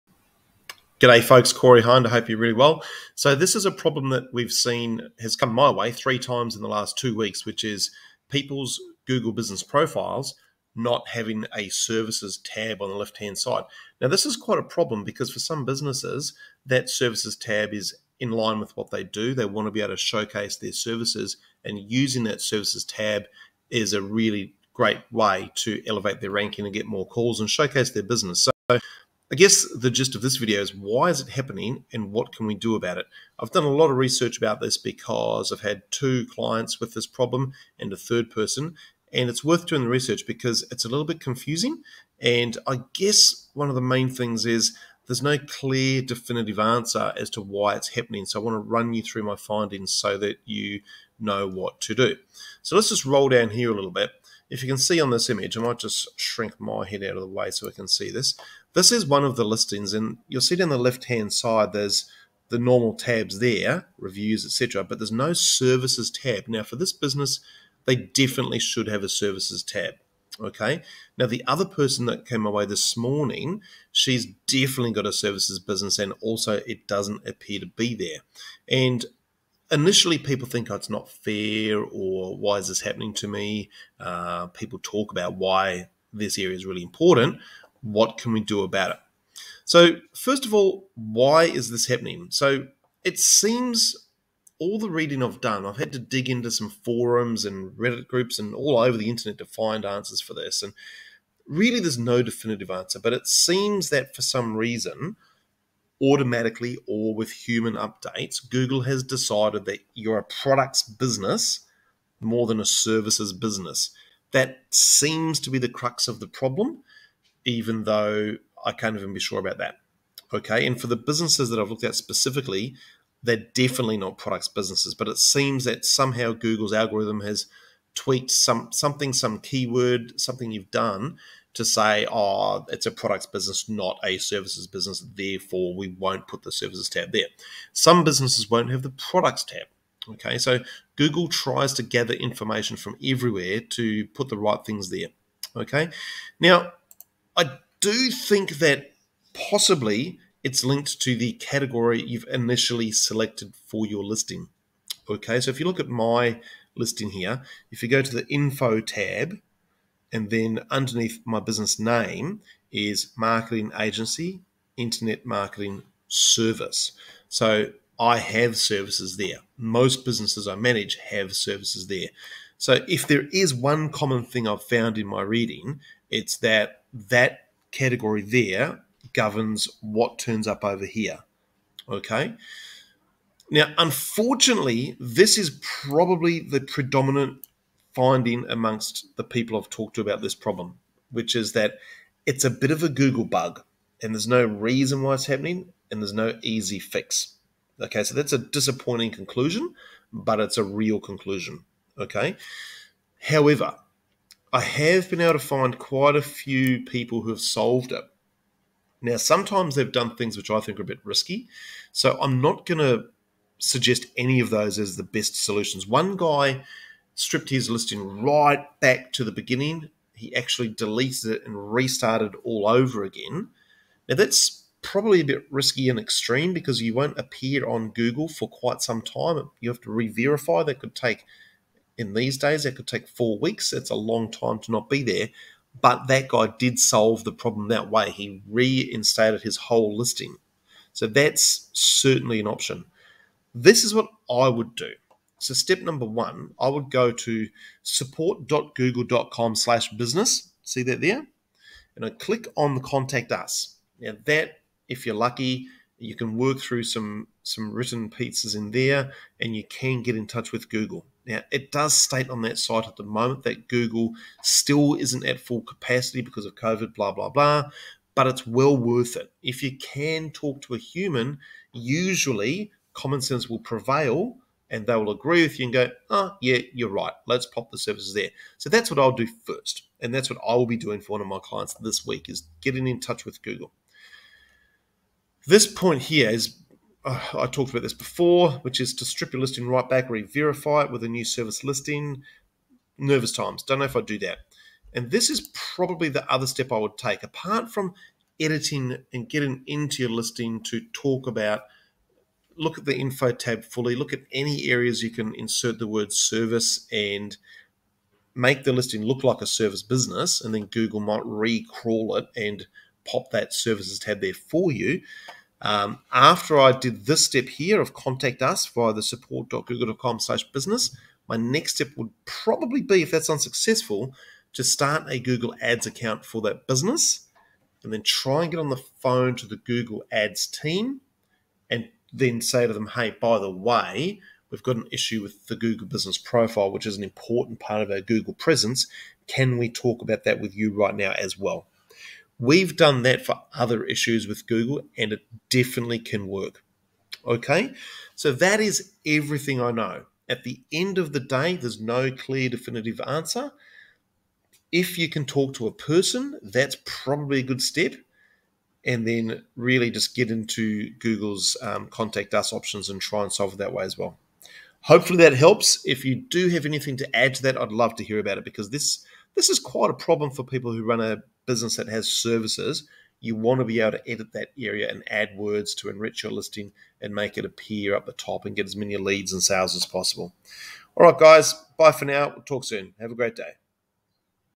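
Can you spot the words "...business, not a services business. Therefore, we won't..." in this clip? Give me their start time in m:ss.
2:13.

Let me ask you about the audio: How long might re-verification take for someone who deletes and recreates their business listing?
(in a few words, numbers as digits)
4 weeks.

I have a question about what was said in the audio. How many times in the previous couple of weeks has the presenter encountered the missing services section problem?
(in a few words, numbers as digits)
3.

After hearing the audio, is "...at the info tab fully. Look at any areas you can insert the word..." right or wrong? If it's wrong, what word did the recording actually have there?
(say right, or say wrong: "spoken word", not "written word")
right.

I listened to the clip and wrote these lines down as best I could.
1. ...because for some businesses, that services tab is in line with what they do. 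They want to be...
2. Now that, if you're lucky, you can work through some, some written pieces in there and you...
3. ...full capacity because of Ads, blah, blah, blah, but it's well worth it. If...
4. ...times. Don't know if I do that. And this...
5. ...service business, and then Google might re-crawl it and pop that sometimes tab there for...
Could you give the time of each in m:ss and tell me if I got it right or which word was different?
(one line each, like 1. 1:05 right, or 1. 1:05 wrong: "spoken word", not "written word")
1. 0:15 right
2. 4:13 right
3. 4:25 wrong: "COVID", not "Ads"
4. 4:53 right
5. 5:09 wrong: "services", not "sometimes".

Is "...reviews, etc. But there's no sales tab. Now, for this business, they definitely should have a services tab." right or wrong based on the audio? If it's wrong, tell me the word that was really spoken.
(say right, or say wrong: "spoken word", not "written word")
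wrong: "services", not "sales".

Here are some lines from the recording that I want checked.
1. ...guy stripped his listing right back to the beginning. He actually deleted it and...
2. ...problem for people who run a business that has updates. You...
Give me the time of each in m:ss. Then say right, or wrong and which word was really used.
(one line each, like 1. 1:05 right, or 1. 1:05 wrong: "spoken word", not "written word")
1. 3:36 right
2. 6:09 wrong: "services", not "updates".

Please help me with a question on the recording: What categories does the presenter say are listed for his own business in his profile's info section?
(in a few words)
marketing agency, internet marketing service.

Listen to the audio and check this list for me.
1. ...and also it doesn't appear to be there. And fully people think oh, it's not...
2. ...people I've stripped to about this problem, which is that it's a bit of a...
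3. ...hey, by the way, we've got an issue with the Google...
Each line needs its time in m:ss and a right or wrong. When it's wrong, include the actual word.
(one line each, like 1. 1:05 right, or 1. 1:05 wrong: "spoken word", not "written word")
1. 1:15 wrong: "initially", not "fully"
2. 3:09 wrong: "talked", not "stripped"
3. 5:32 right.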